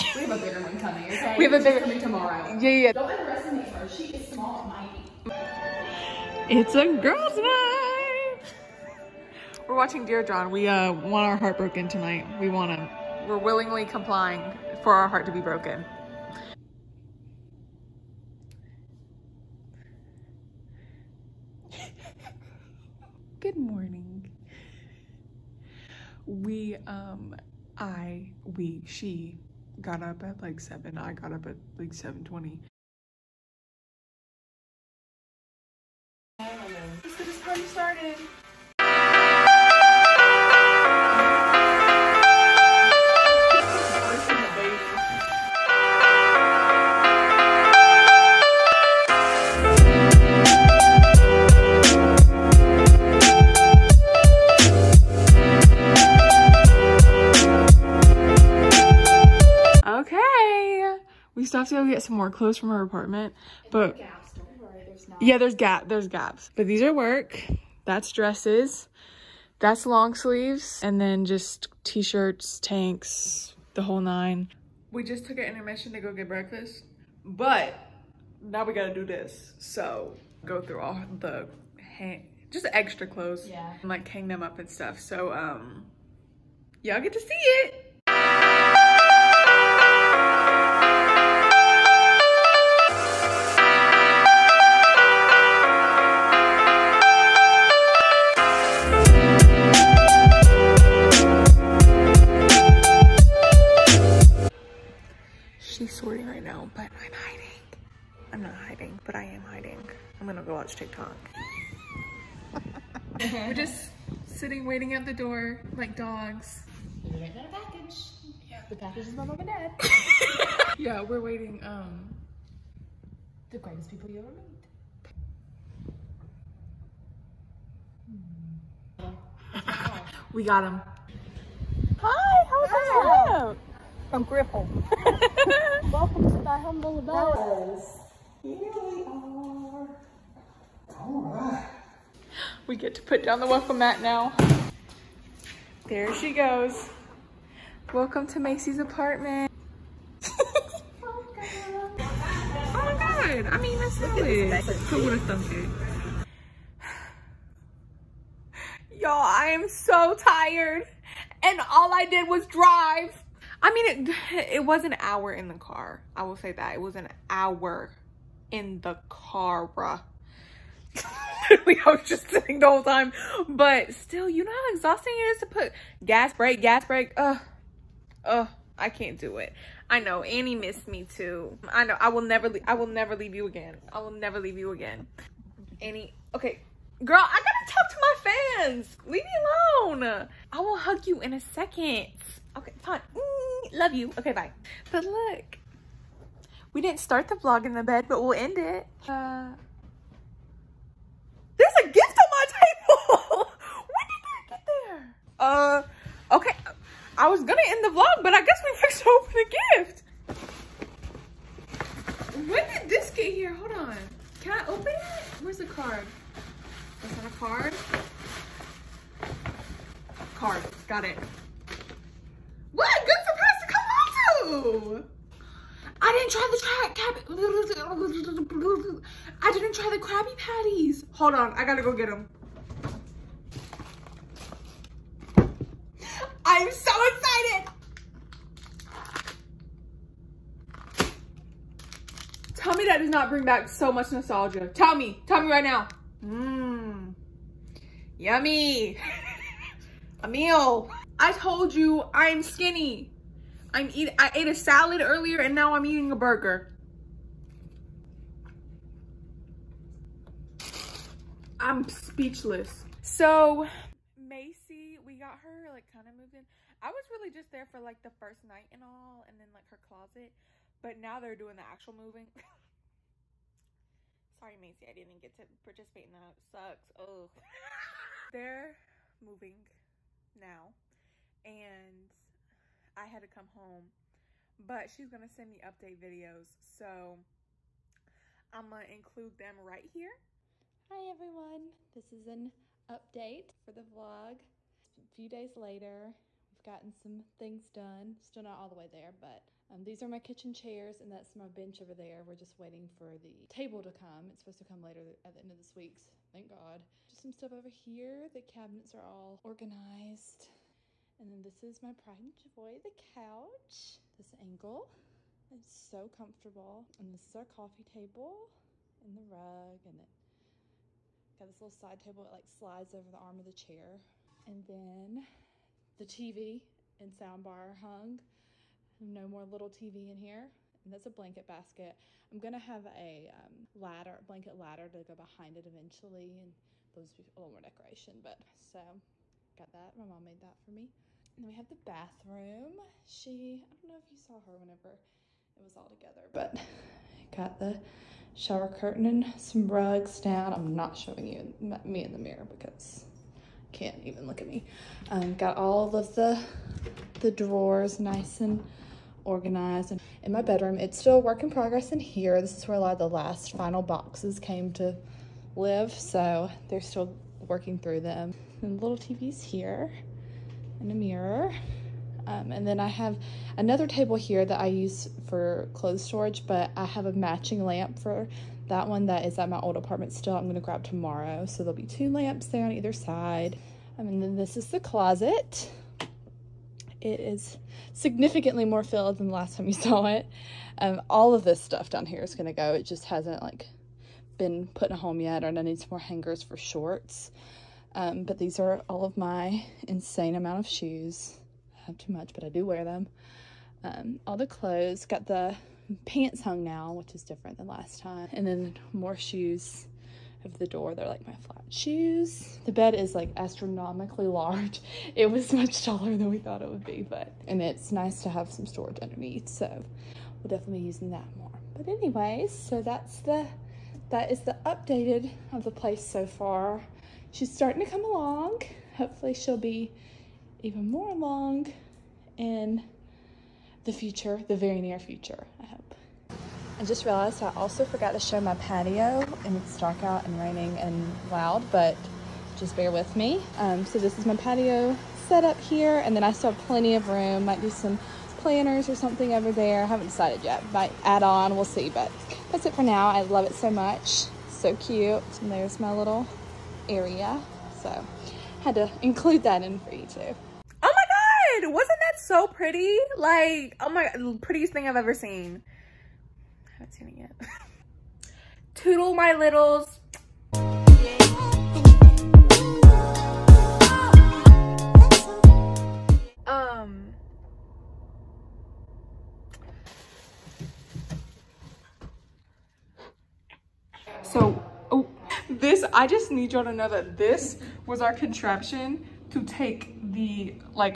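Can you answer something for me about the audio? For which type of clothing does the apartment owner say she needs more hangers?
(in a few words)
shorts.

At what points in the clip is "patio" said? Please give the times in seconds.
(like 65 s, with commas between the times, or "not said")
438 s, 444 s.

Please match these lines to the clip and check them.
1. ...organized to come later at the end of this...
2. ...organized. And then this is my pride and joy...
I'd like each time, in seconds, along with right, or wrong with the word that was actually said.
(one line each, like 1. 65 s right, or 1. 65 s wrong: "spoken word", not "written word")
1. 304 s wrong: "supposed", not "organized"
2. 309 s right.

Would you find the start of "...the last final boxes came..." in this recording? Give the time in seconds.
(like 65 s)
362 s.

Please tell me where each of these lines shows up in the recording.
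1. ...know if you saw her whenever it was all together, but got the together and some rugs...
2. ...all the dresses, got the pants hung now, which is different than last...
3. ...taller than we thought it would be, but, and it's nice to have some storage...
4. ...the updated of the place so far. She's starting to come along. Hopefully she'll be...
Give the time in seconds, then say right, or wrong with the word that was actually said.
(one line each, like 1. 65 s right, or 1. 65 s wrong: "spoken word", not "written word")
1. 343 s wrong: "shower", not "together"
2. 404 s wrong: "clothes", not "dresses"
3. 415 s right
4. 424 s right.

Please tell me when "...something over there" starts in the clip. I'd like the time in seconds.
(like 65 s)
448 s.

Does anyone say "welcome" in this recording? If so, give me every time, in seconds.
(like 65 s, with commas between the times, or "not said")
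135 s, 143 s, 147 s.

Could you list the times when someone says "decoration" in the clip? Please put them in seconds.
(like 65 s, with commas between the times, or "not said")
337 s.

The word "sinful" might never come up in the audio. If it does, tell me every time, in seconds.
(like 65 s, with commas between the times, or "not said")
not said.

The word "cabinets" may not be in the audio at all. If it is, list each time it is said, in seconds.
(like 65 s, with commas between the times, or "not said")
308 s.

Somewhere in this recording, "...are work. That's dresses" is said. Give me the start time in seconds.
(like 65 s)
66 s.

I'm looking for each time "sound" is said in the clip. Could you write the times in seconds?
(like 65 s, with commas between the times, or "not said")
327 s.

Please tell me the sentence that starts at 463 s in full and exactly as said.
Like, oh my, prettiest thing I've ever seen.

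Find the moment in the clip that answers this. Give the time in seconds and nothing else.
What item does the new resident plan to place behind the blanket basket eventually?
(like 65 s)
334 s.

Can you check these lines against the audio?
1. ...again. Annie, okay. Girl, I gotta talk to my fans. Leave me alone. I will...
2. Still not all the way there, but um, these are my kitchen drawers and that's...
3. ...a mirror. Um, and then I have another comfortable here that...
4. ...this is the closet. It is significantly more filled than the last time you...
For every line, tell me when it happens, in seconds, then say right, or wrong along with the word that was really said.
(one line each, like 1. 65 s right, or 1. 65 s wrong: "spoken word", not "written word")
1. 184 s right
2. 298 s wrong: "chairs", not "drawers"
3. 370 s wrong: "table", not "comfortable"
4. 384 s right.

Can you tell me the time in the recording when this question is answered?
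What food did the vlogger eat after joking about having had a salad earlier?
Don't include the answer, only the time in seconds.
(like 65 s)
256 s.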